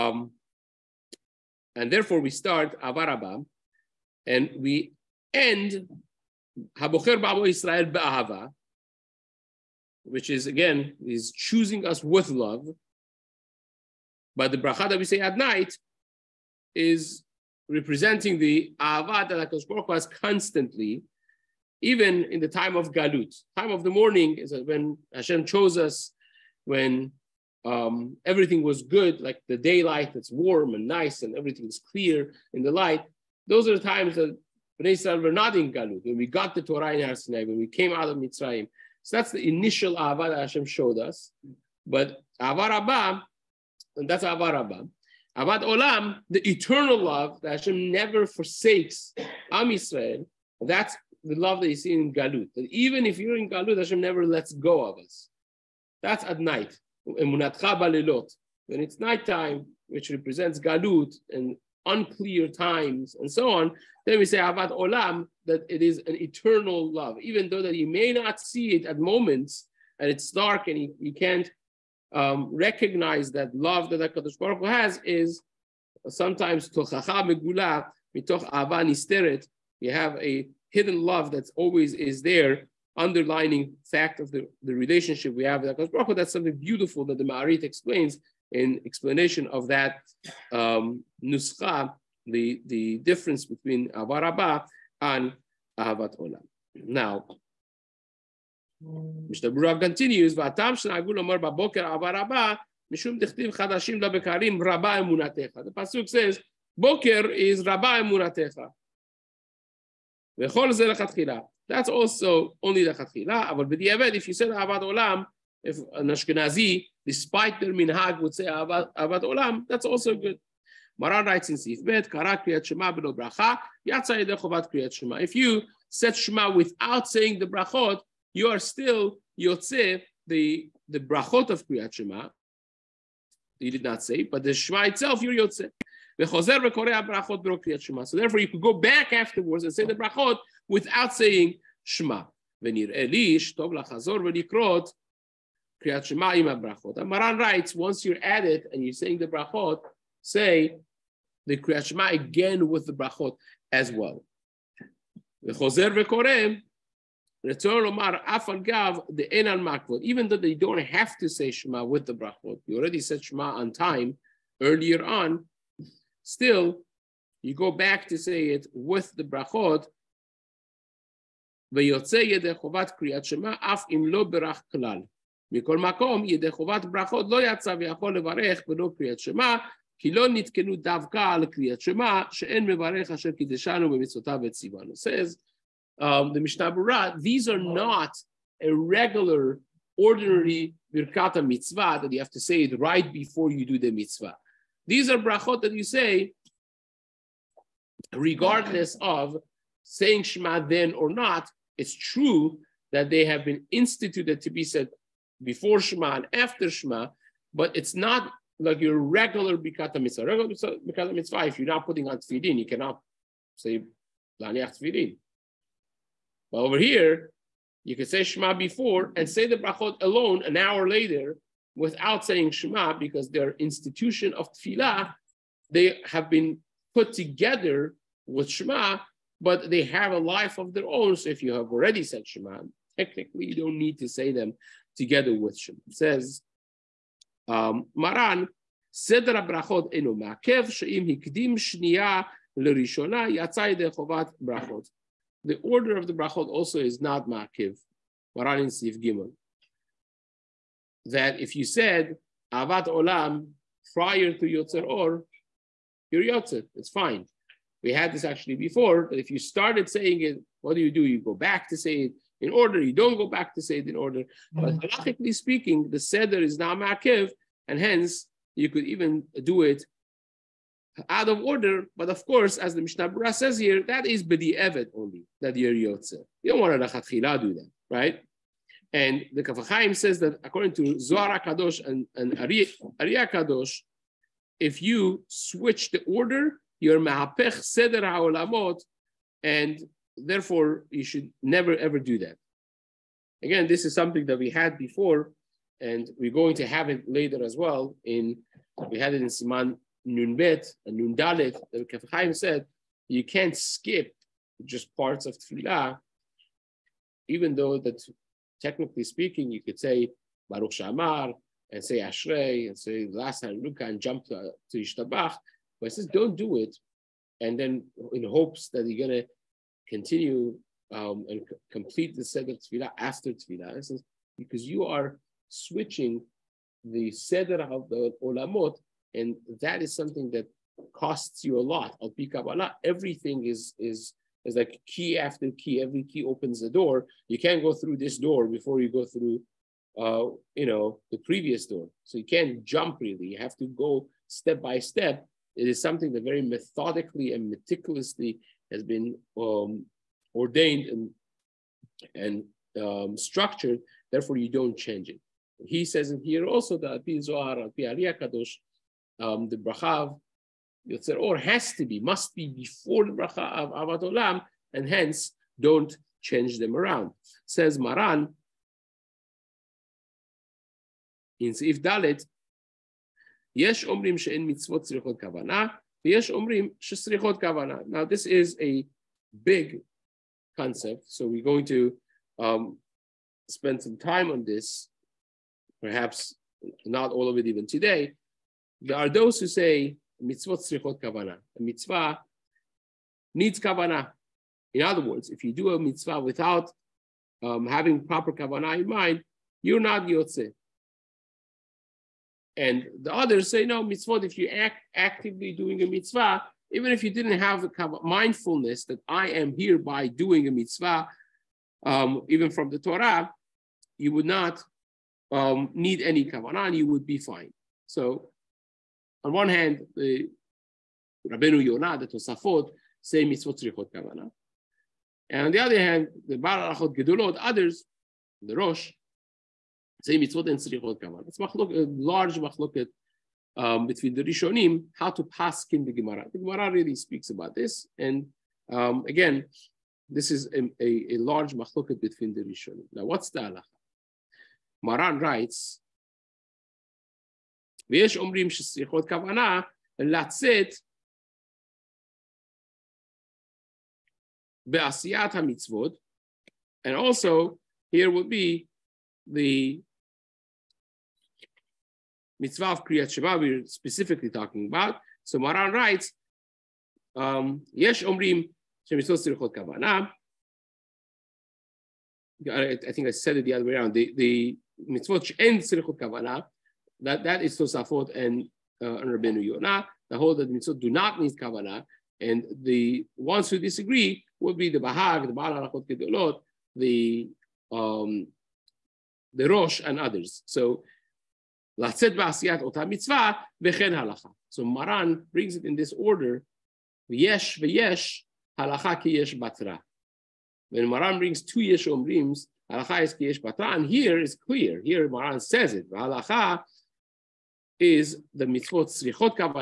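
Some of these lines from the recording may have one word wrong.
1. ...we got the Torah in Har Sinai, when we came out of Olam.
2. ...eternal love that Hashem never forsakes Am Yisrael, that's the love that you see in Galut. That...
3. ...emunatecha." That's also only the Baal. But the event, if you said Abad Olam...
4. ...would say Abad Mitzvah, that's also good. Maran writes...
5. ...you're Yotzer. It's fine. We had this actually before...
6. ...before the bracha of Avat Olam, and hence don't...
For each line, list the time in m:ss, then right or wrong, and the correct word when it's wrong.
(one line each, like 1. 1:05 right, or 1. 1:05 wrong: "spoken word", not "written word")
1. 0:36 wrong: "Mitzrayim", not "Olam"
2. 0:46 right
3. 1:48 wrong: "Khatkhila", not "Baal"
4. 1:58 wrong: "Olam", not "Mitzvah"
5. 4:16 right
6. 6:02 right.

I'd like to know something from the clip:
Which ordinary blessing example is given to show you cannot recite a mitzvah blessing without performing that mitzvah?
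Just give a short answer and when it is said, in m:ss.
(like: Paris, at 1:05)
Laniach Tefillin, at 3:34.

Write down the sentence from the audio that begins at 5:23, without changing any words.
It says because you are switching the Seder of the Olamot.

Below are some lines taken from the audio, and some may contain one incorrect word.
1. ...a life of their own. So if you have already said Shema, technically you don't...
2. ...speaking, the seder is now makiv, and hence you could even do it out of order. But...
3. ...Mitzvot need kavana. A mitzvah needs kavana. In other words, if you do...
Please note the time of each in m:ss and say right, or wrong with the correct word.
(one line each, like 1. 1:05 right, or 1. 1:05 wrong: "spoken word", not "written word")
1. 3:50 right
2. 4:25 right
3. 6:30 right.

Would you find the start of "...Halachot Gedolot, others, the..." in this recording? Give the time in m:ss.
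7:06.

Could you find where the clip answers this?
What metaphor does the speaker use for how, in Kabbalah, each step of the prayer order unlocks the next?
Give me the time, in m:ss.
5:34.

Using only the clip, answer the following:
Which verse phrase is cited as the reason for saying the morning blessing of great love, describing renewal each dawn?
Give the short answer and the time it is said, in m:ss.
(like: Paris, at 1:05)
Chadashim labekarim, at 1:43.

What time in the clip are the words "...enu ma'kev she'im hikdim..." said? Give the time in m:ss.
3:59.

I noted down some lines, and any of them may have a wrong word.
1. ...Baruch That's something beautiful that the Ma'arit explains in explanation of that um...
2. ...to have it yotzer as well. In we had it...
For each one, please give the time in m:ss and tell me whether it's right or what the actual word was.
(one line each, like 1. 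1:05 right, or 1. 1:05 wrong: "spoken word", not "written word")
1. 1:25 right
2. 4:56 wrong: "later", not "yotzer".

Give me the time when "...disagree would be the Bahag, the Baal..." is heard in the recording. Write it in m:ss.
8:03.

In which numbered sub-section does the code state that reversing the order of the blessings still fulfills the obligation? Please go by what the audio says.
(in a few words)
Gimel.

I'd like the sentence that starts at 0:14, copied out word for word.
But the bracha that we say at night is representing the Ahava that HaKadosh has constantly even in the time of Galut.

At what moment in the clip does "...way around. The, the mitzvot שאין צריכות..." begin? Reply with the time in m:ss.
7:53.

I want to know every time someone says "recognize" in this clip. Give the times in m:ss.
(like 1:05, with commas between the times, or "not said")
1:12.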